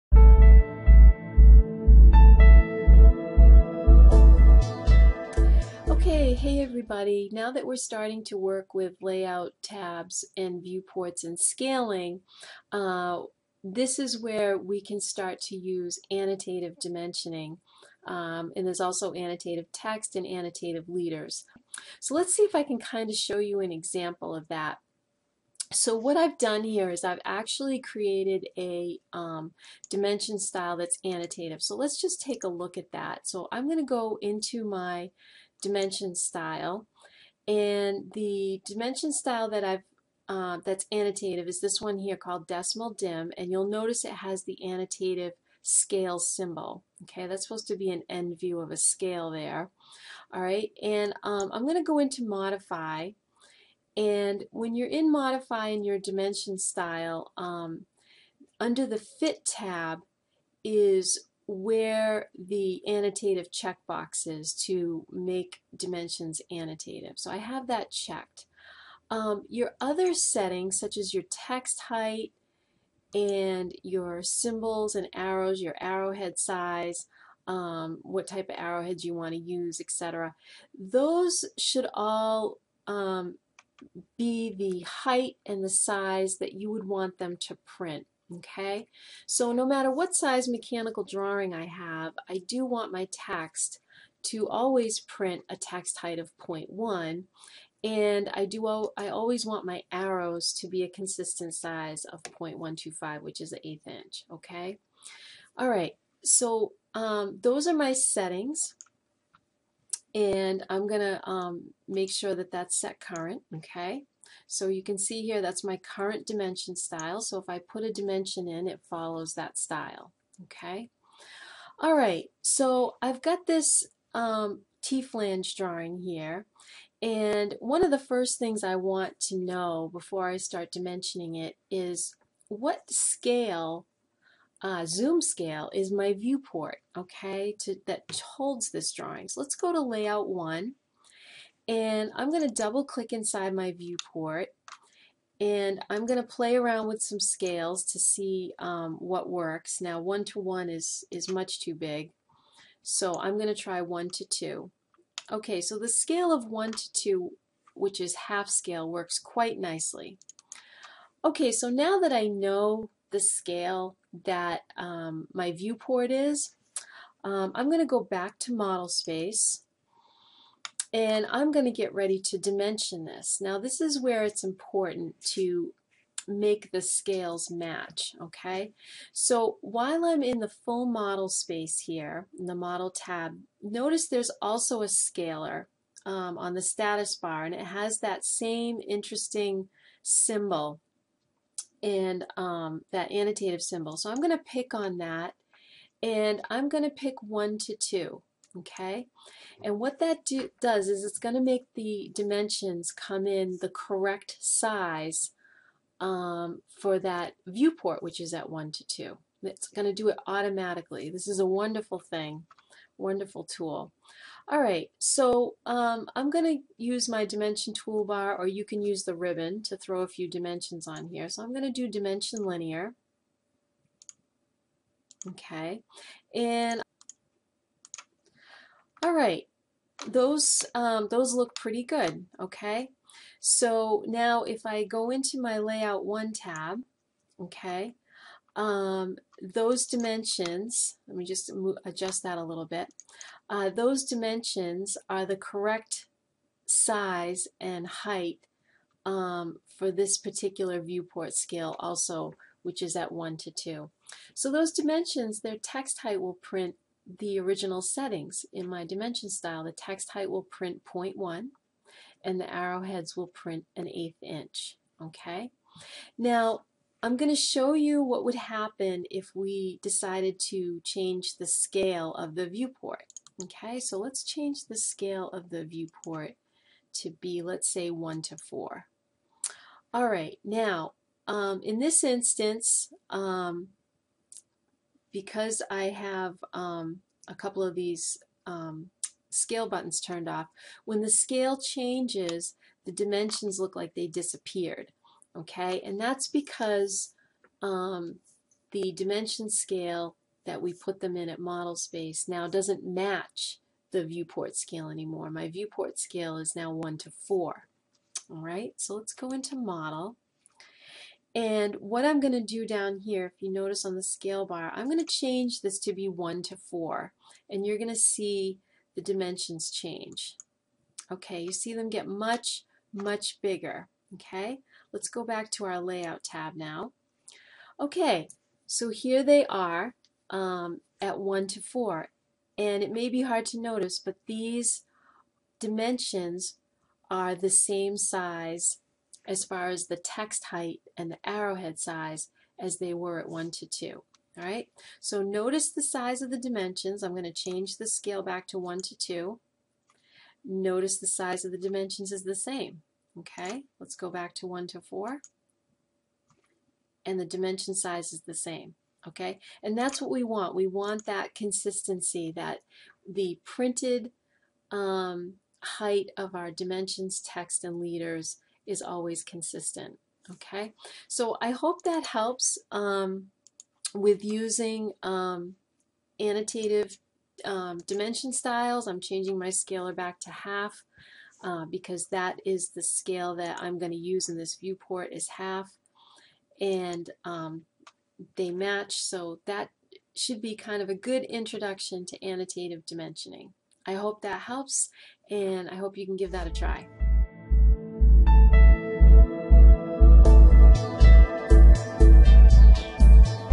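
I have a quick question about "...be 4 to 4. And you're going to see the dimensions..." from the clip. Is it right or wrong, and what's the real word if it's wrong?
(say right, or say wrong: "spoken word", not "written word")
wrong: "1", not "4".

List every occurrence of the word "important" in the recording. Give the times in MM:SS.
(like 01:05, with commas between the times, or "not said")
02:54.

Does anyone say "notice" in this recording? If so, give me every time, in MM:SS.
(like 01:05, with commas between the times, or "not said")
00:43, 03:03, 05:13, 05:33, 05:45, 05:50.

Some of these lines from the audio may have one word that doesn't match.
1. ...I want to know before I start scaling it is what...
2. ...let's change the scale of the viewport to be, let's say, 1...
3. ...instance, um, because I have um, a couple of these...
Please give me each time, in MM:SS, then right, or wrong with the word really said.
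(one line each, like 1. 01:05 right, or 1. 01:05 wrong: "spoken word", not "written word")
1. 02:08 wrong: "dimensioning", not "scaling"
2. 04:33 right
3. 04:42 right.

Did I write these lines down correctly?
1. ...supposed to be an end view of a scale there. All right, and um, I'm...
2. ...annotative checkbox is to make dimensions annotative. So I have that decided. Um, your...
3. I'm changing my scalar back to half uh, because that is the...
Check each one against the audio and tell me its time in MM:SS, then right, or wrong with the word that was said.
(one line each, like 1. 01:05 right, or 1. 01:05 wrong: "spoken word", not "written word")
1. 00:47 right
2. 01:02 wrong: "checked", not "decided"
3. 06:18 right.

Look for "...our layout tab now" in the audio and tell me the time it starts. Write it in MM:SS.
05:25.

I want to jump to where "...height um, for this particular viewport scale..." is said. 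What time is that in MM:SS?
04:07.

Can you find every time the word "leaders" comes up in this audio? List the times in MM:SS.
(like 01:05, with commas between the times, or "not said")
00:20, 06:07.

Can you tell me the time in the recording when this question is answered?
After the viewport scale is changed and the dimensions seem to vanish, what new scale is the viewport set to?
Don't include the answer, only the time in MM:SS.
05:05.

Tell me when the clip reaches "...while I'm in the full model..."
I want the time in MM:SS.
02:59.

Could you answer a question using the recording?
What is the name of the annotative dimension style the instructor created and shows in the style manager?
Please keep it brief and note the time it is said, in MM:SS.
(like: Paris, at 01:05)
decimal dim, at 00:42.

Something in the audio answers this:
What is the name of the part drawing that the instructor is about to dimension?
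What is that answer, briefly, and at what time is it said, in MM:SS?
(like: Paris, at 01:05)
T-flange, at 02:04.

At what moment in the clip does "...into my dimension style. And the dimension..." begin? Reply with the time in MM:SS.
00:34.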